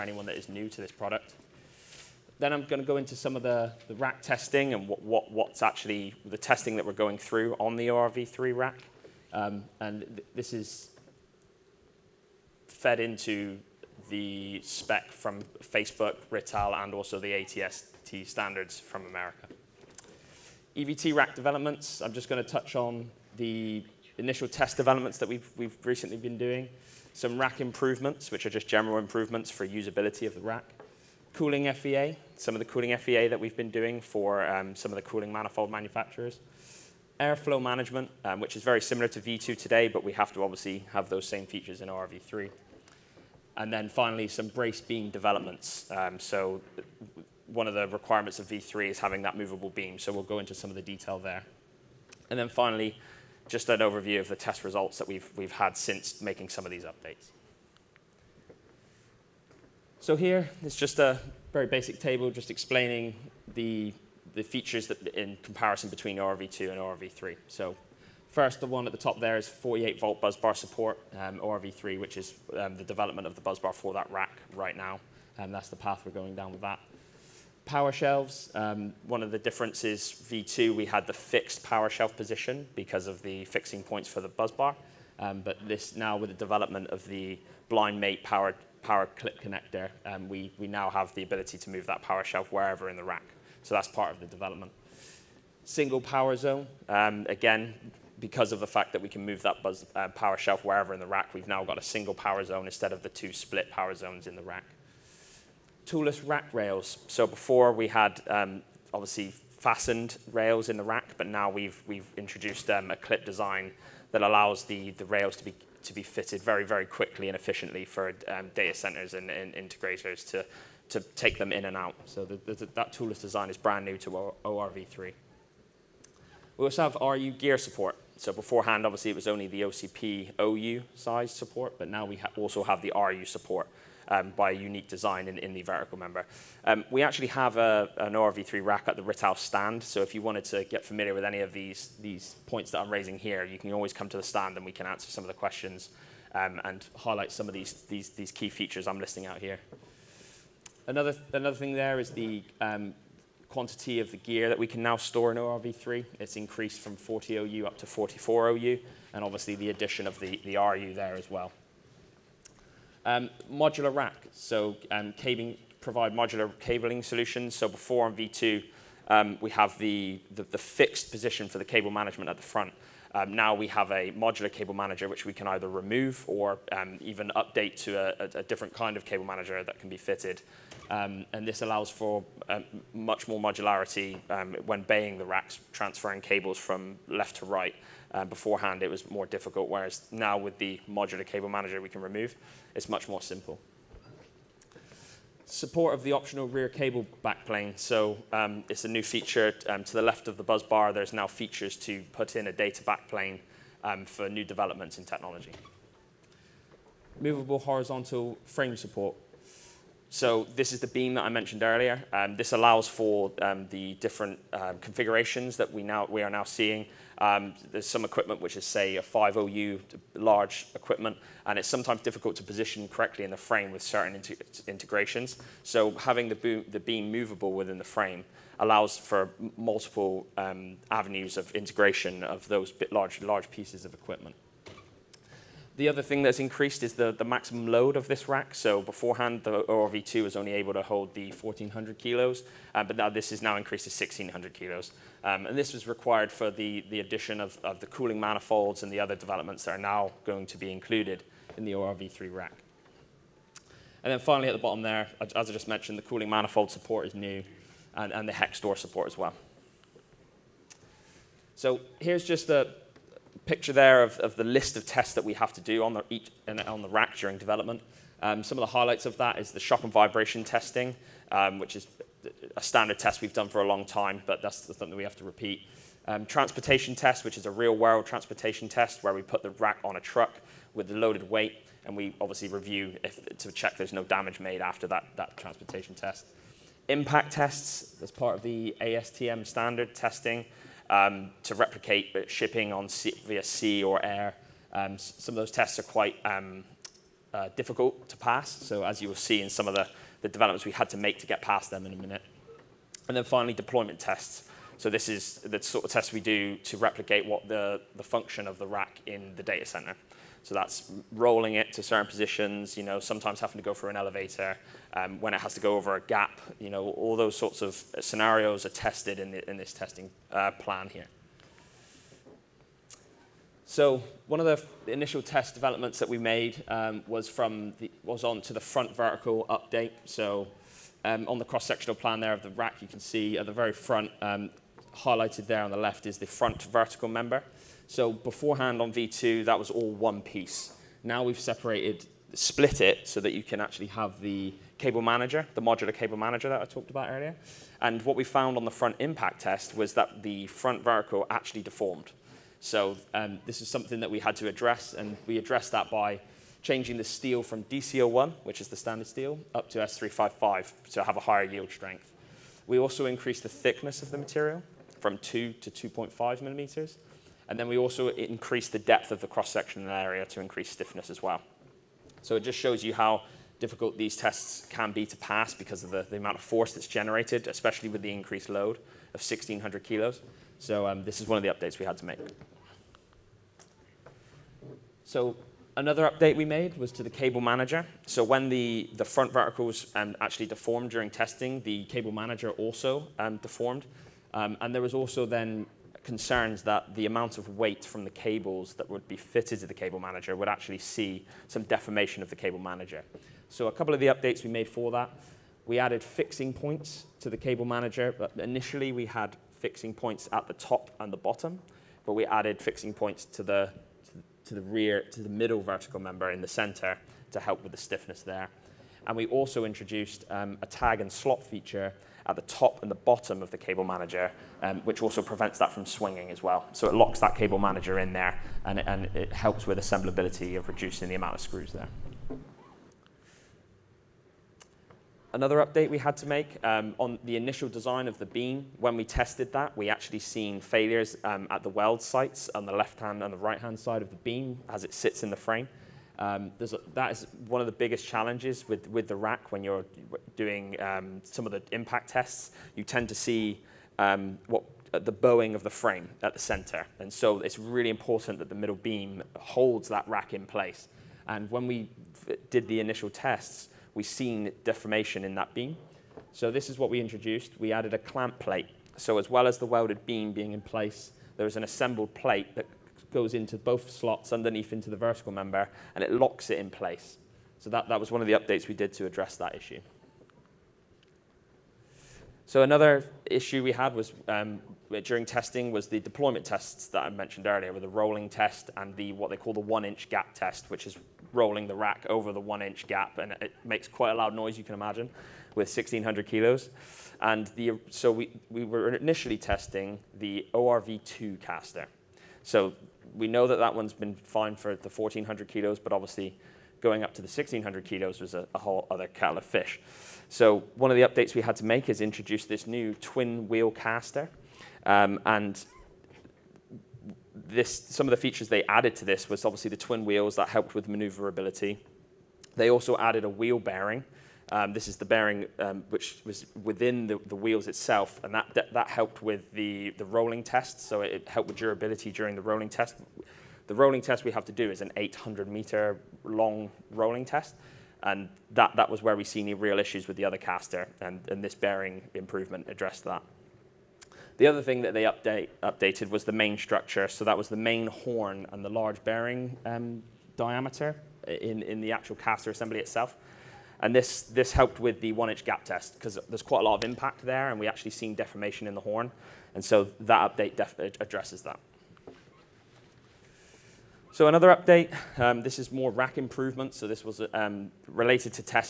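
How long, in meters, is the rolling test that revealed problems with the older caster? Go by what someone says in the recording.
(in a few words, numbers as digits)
800 meters.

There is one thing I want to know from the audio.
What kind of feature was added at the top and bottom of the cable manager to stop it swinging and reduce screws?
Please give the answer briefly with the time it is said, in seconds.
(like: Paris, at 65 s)
tag and slot, at 420 s.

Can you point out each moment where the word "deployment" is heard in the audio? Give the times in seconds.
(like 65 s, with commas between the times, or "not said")
303 s, 485 s.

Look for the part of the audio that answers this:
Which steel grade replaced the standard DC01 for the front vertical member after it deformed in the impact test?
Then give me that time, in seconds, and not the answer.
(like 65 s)
359 s.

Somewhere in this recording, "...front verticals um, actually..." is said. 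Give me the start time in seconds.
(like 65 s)
389 s.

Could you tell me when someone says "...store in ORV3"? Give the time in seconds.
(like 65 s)
154 s.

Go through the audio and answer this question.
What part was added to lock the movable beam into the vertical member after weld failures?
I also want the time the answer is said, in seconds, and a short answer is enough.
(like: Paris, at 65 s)
clamp plate, at 467 s.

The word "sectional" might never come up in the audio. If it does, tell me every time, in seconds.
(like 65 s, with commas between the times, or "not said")
331 s, 369 s.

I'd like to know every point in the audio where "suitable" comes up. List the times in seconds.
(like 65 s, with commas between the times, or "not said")
not said.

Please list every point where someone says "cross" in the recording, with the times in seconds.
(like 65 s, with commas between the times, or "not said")
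331 s, 369 s.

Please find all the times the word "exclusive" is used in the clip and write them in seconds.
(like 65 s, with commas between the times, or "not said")
not said.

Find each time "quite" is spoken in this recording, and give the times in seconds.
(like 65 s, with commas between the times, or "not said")
295 s, 493 s, 556 s.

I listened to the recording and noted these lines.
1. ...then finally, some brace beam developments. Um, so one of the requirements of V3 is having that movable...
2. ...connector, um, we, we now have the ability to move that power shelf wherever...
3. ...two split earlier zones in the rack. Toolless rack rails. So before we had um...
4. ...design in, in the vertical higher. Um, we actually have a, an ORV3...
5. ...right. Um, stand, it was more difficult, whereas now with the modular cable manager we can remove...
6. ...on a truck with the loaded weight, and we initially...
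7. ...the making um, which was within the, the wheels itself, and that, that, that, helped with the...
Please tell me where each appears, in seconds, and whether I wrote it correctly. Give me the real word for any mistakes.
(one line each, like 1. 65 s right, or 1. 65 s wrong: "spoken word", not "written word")
1. 43 s right
2. 89 s right
3. 103 s wrong: "power", not "earlier"
4. 134 s wrong: "member", not "higher"
5. 187 s wrong: "beforehand", not "stand"
6. 279 s wrong: "obviously", not "initially"
7. 524 s wrong: "bearing", not "making".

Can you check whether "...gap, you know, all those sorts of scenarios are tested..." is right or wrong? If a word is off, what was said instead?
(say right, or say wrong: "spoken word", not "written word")
right.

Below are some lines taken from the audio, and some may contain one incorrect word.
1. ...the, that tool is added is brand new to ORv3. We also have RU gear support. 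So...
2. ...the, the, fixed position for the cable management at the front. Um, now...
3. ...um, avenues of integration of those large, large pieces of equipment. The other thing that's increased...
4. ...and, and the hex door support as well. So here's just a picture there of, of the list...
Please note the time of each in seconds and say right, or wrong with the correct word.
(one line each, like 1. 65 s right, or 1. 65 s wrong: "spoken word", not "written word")
1. 122 s wrong: "designed", not "added"
2. 170 s right
3. 230 s right
4. 257 s right.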